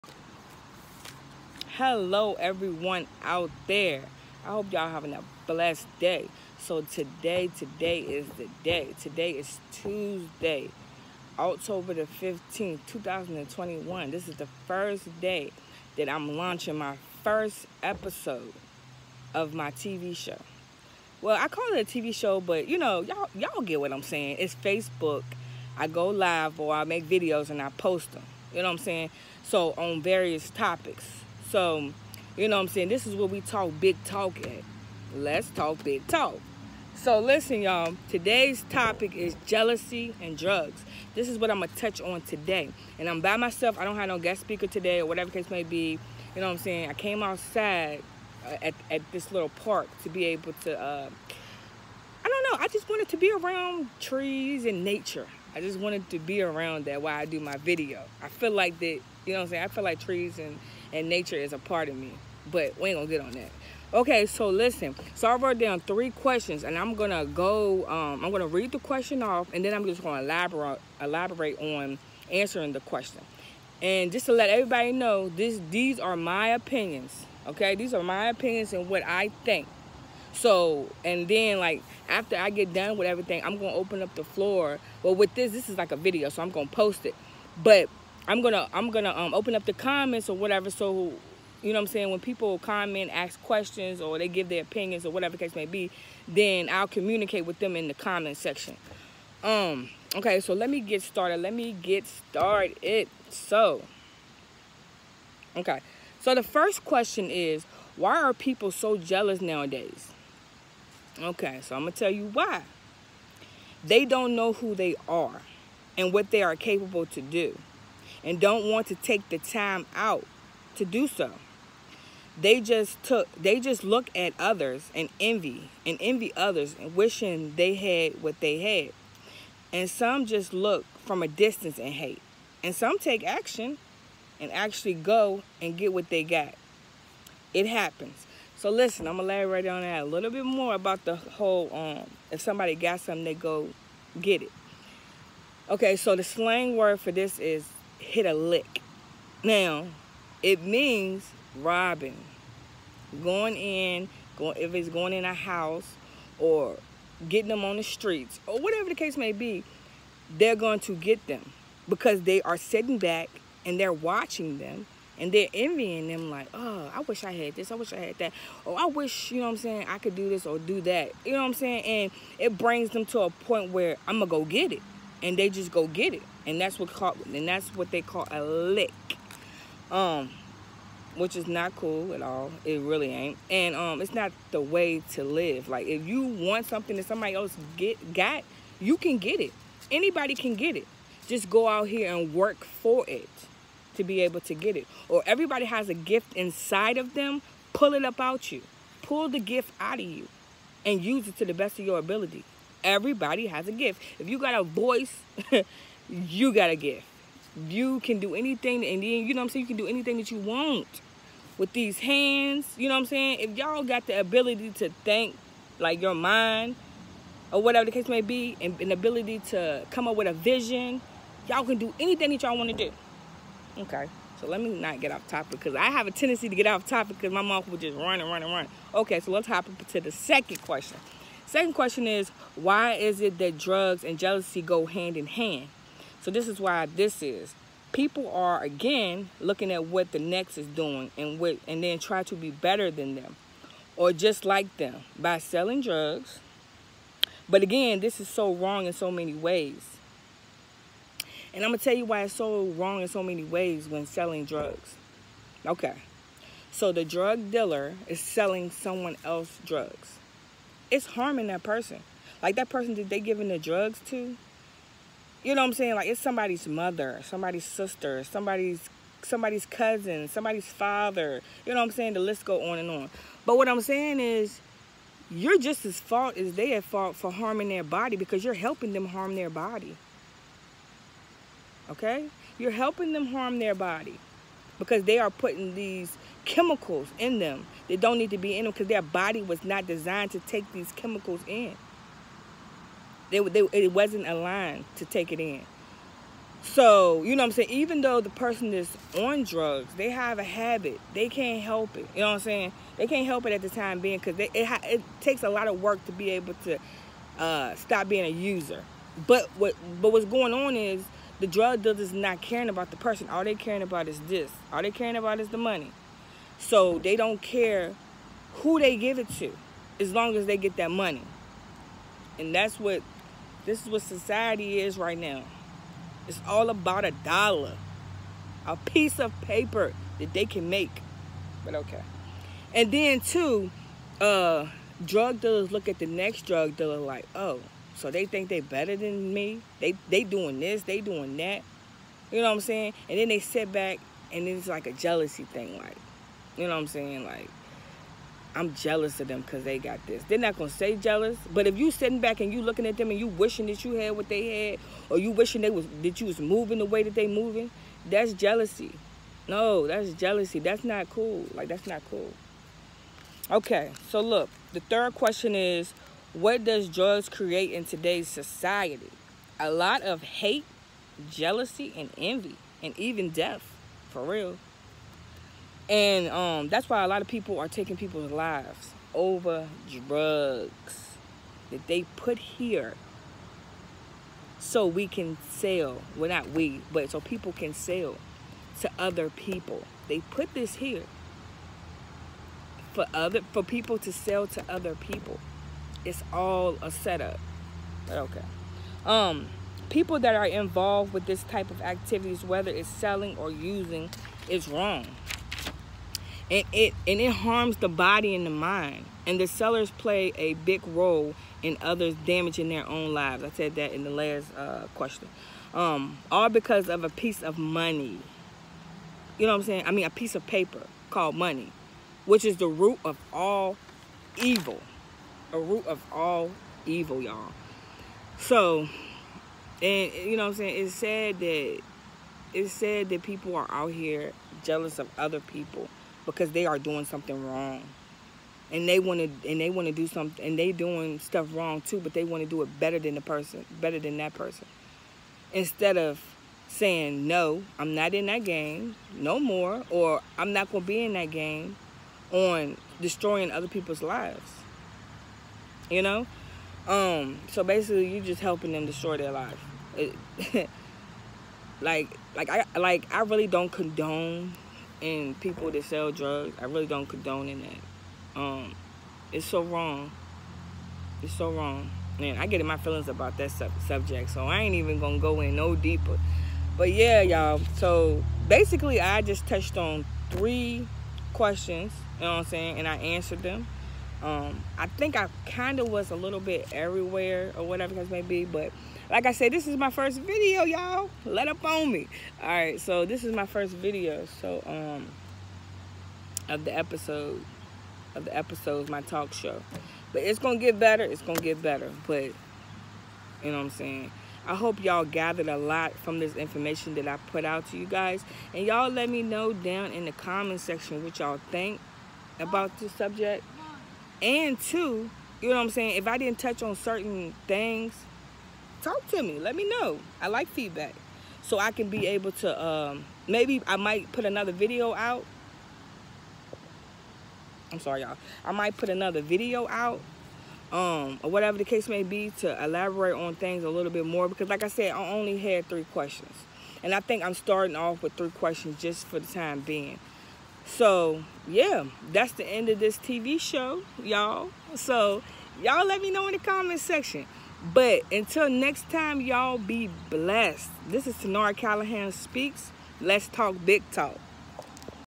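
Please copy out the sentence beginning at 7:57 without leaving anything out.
So basically, I just touched on three questions.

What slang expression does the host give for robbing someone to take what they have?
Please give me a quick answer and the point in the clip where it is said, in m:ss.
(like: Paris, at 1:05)
hit a lick, at 2:28.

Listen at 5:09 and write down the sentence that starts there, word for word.
But what but what's going on is the drug dealer is not caring about the person.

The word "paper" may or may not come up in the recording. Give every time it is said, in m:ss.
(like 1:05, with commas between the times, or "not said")
5:29, 7:00.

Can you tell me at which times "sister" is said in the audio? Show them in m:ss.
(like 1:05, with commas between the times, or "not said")
4:27.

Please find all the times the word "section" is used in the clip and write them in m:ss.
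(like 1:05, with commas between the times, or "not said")
1:38, 8:30, 9:06.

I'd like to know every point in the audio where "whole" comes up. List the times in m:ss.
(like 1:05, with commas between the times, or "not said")
2:21.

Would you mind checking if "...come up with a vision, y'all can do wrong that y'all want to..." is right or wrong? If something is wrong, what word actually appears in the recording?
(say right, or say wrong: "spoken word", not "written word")
wrong: "anything", not "wrong".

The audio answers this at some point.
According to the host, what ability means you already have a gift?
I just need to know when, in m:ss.
3:24.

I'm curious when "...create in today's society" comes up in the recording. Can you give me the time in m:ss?
6:07.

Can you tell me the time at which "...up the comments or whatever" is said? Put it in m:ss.
1:29.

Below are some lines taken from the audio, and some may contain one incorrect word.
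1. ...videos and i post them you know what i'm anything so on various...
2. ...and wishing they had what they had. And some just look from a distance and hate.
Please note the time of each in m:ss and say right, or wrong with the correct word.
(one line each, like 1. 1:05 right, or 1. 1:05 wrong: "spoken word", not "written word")
1. 0:27 wrong: "saying", not "anything"
2. 2:06 right.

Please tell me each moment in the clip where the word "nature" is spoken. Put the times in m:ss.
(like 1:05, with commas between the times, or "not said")
0:54, 1:01.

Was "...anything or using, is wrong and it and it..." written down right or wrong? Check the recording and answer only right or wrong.
wrong.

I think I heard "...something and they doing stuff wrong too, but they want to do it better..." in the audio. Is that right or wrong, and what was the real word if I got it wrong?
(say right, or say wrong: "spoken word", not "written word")
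right.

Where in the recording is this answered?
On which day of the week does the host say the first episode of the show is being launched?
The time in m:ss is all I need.
0:09.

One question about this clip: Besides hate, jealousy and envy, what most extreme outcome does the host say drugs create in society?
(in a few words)
death.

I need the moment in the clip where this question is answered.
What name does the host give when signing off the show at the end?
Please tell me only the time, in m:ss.
9:11.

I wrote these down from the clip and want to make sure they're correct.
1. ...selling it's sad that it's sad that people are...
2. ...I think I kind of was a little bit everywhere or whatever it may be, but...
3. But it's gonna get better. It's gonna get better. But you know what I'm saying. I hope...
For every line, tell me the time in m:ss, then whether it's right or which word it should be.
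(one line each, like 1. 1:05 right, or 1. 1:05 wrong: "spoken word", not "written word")
1. 7:10 wrong: "saying", not "selling"
2. 8:04 right
3. 8:20 right.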